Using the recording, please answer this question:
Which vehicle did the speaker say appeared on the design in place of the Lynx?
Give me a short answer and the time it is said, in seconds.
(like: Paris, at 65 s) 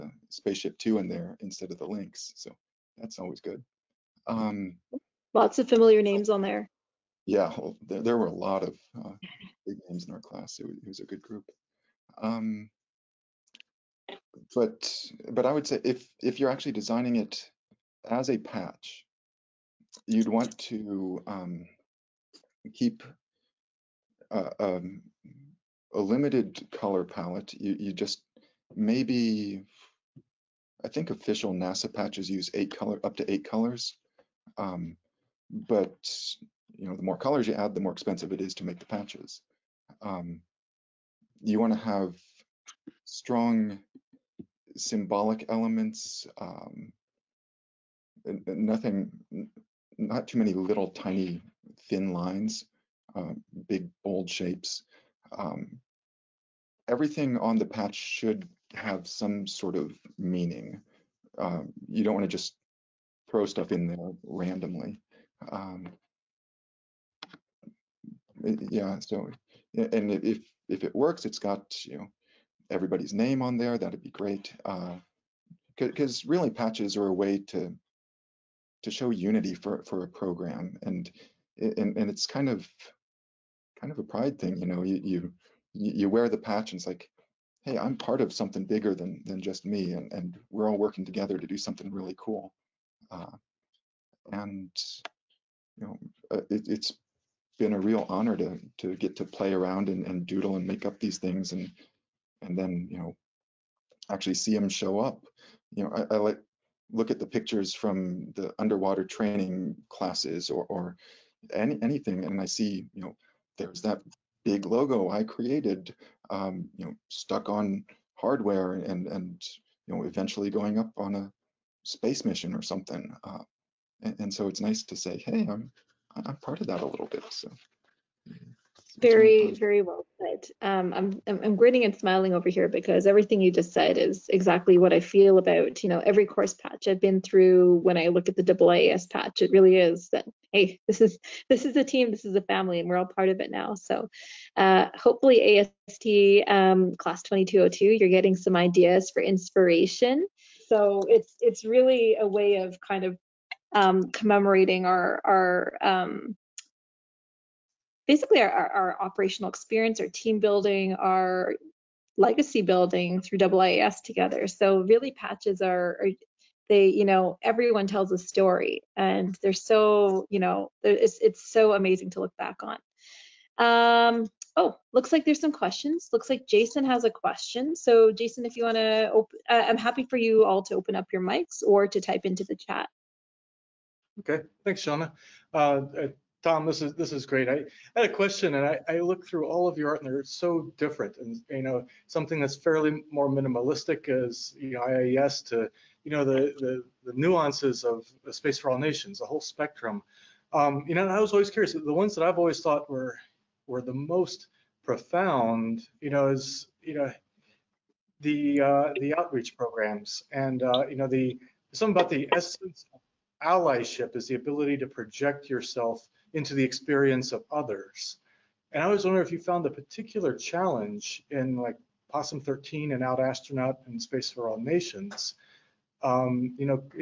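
SpaceShip Two, at 0 s.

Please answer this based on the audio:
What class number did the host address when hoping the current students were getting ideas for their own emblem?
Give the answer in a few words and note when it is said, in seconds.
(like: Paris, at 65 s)
2202, at 147 s.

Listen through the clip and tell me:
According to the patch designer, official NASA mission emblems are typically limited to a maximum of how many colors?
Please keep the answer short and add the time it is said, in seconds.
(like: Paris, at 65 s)
8, at 32 s.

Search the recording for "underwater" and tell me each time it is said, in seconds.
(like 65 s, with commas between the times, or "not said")
108 s.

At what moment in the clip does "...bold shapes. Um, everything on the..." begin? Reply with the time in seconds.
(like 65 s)
54 s.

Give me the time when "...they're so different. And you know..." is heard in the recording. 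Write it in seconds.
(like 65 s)
190 s.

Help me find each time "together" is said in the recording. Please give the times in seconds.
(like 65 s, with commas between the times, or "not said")
91 s, 164 s.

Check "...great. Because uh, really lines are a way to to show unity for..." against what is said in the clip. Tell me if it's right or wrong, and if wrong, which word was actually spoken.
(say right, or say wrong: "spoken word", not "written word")
wrong: "patches", not "lines".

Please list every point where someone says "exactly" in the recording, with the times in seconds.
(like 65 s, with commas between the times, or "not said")
134 s.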